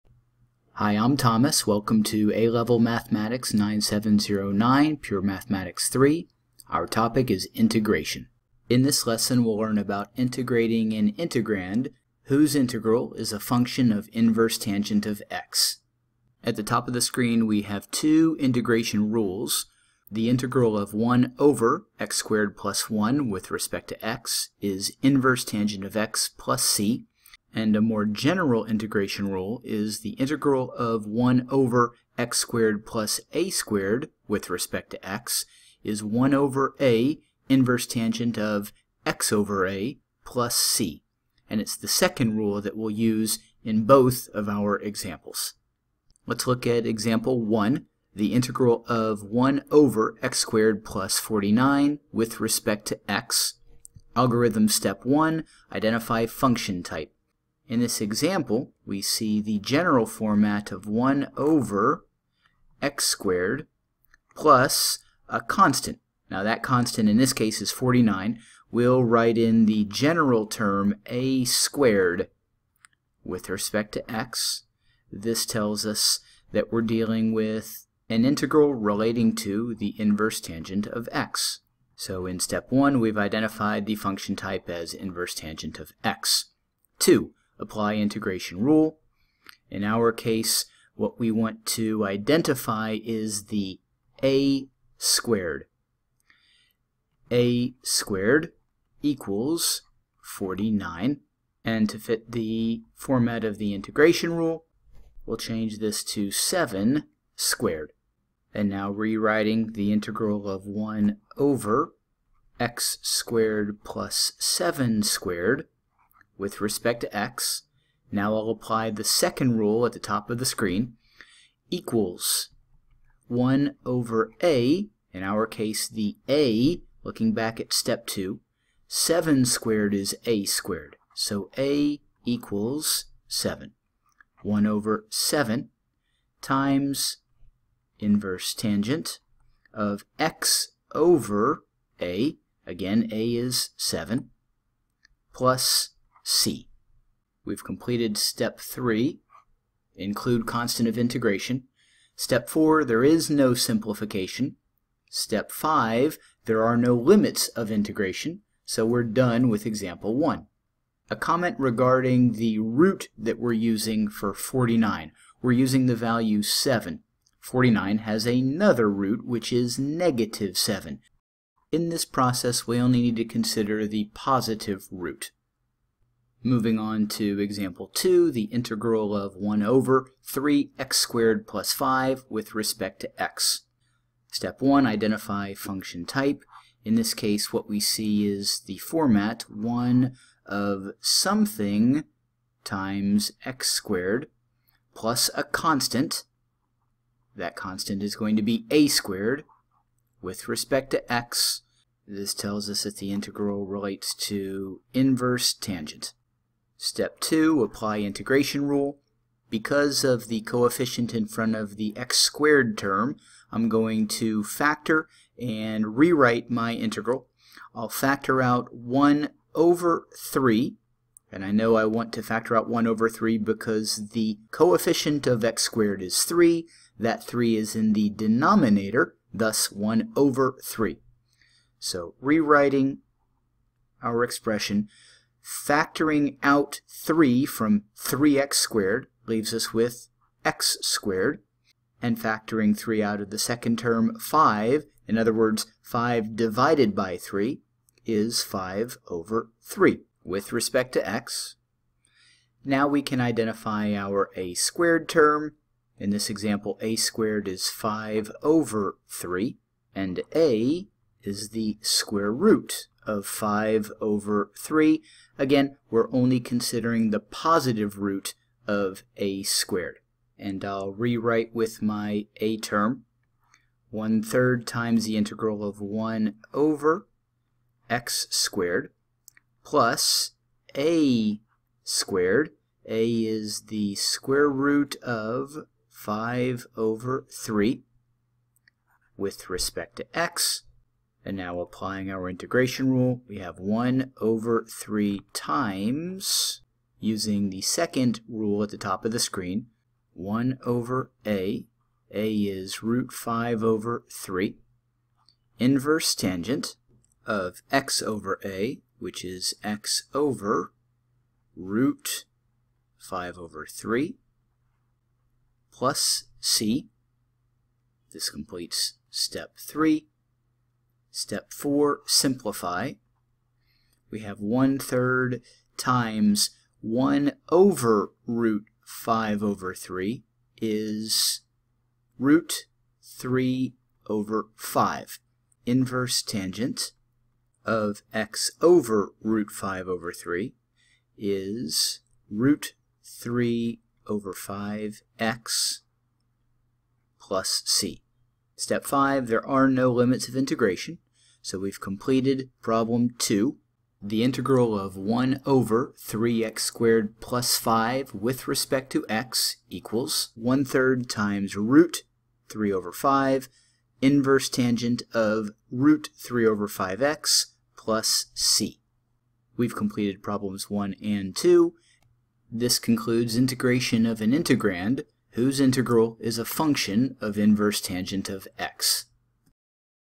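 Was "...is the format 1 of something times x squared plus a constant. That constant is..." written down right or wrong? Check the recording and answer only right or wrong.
right.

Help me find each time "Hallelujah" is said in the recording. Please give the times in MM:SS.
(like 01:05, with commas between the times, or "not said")
not said.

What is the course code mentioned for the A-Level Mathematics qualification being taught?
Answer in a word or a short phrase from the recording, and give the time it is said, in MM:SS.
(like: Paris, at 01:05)
9709, at 00:03.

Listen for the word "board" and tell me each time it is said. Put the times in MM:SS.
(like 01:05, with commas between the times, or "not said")
not said.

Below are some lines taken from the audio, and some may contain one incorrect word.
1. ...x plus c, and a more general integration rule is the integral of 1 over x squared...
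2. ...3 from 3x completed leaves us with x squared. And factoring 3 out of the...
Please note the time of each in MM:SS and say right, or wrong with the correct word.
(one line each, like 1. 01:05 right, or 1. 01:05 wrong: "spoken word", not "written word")
1. 00:25 right
2. 03:56 wrong: "squared", not "completed".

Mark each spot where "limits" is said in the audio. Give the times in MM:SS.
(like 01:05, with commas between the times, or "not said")
02:36, 05:49.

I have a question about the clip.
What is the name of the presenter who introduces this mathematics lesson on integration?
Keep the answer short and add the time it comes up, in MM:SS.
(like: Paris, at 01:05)
Thomas, at 00:01.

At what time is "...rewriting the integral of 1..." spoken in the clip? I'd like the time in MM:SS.
01:48.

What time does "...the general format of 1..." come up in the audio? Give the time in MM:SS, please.
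00:59.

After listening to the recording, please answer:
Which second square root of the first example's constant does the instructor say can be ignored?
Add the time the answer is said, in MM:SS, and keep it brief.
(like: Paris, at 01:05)
-7, at 02:49.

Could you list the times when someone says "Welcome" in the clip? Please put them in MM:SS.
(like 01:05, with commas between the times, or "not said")
00:01.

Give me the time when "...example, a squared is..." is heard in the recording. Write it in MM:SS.
04:16.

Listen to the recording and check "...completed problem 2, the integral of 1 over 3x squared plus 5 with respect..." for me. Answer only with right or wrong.
right.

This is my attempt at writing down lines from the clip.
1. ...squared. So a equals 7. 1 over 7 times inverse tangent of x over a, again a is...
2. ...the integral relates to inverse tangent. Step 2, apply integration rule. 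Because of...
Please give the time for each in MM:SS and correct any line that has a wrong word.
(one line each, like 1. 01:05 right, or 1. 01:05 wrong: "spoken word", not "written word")
1. 02:10 right
2. 03:22 right.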